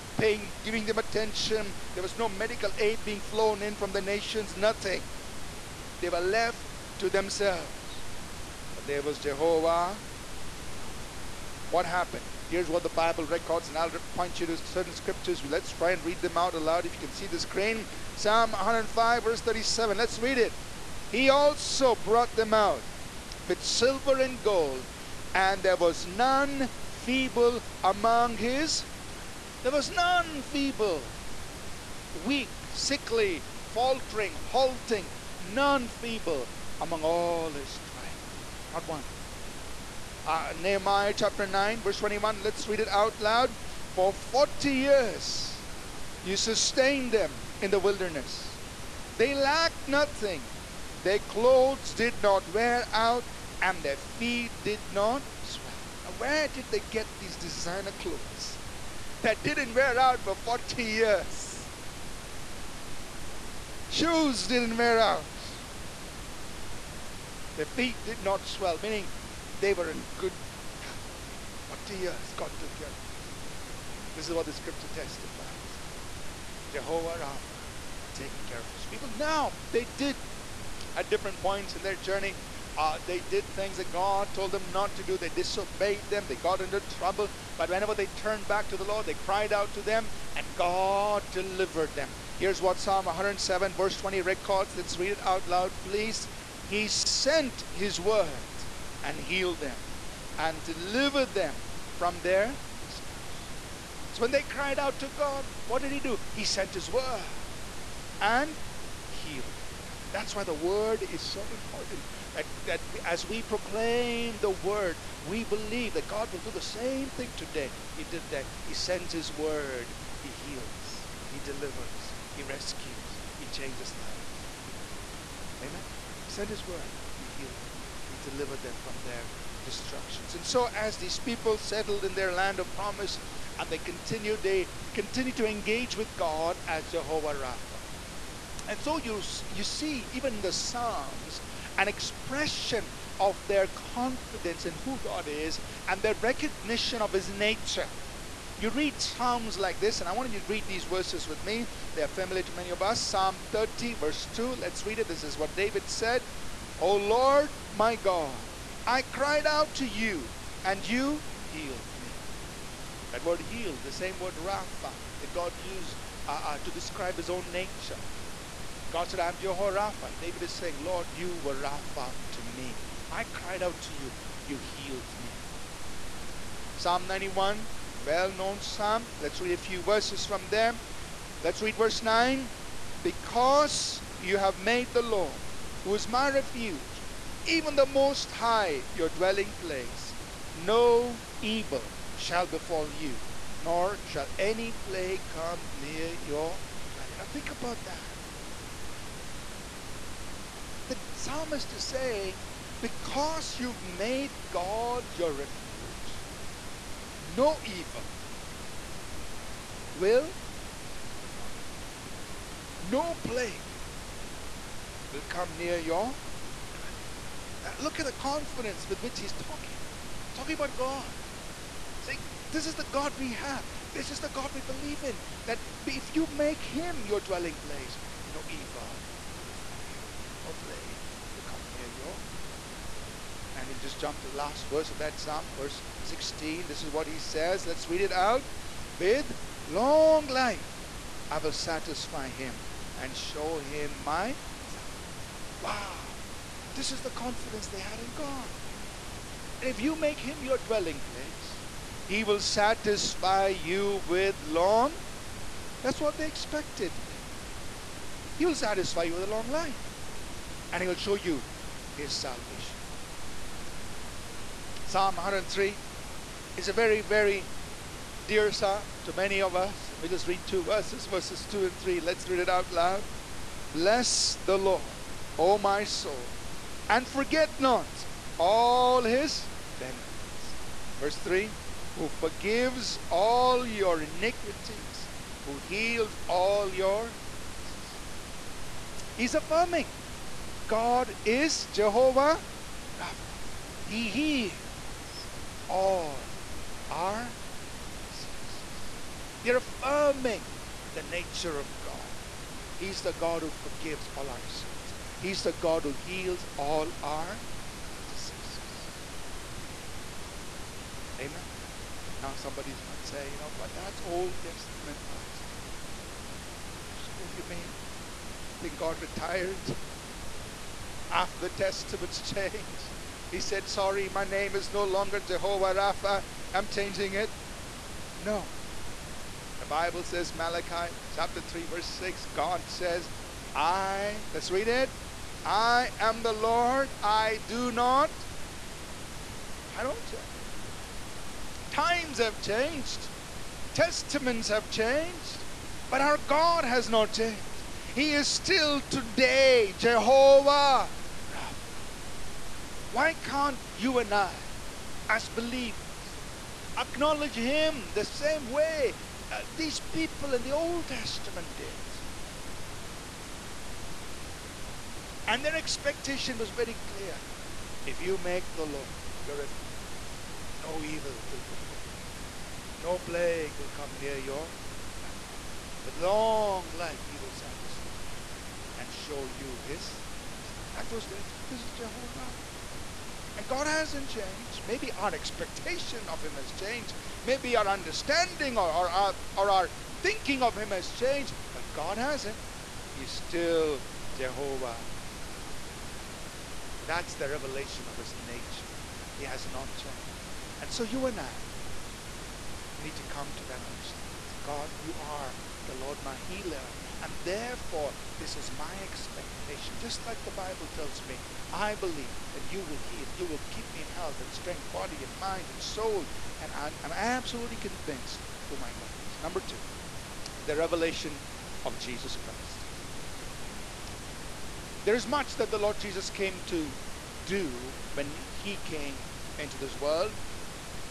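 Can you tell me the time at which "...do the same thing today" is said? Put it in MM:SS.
01:56.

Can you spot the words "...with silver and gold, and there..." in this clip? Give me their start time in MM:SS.
00:23.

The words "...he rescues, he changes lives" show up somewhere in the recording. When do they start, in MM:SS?
02:02.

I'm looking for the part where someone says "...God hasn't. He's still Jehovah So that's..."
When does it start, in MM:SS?
06:31.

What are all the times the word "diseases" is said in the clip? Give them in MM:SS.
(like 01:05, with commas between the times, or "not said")
04:47, 04:58, 05:08.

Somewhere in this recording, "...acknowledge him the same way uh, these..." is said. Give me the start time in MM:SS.
05:56.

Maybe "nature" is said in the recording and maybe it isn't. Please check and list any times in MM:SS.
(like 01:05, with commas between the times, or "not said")
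02:27, 02:47, 05:01, 06:38.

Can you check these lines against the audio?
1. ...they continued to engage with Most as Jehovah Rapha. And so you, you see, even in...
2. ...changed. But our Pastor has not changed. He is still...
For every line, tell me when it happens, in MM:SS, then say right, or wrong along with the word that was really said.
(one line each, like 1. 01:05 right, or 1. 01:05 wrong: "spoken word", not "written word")
1. 02:14 wrong: "God", not "Most"
2. 05:44 wrong: "God", not "Pastor".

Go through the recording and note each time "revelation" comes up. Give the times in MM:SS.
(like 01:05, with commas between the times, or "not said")
06:37, 07:00.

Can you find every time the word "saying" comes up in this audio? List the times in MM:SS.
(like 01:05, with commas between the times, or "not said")
02:50, 03:21.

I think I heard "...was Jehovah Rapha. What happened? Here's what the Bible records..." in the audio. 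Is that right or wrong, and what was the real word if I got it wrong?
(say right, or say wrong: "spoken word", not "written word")
right.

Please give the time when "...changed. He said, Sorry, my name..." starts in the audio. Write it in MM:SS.
05:22.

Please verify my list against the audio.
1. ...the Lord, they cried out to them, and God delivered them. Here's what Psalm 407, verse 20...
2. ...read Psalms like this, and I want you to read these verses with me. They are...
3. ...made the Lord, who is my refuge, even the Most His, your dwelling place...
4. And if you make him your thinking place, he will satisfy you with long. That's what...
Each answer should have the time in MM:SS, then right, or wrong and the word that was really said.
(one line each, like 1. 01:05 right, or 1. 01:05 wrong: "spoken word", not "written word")
1. 01:28 wrong: "107", not "407"
2. 02:28 right
3. 03:04 wrong: "High", not "His"
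4. 04:09 wrong: "dwelling", not "thinking".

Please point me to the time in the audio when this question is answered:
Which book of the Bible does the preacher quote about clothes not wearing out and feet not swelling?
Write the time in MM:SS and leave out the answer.
00:40.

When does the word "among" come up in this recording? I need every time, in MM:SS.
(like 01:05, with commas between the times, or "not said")
00:27, 00:36.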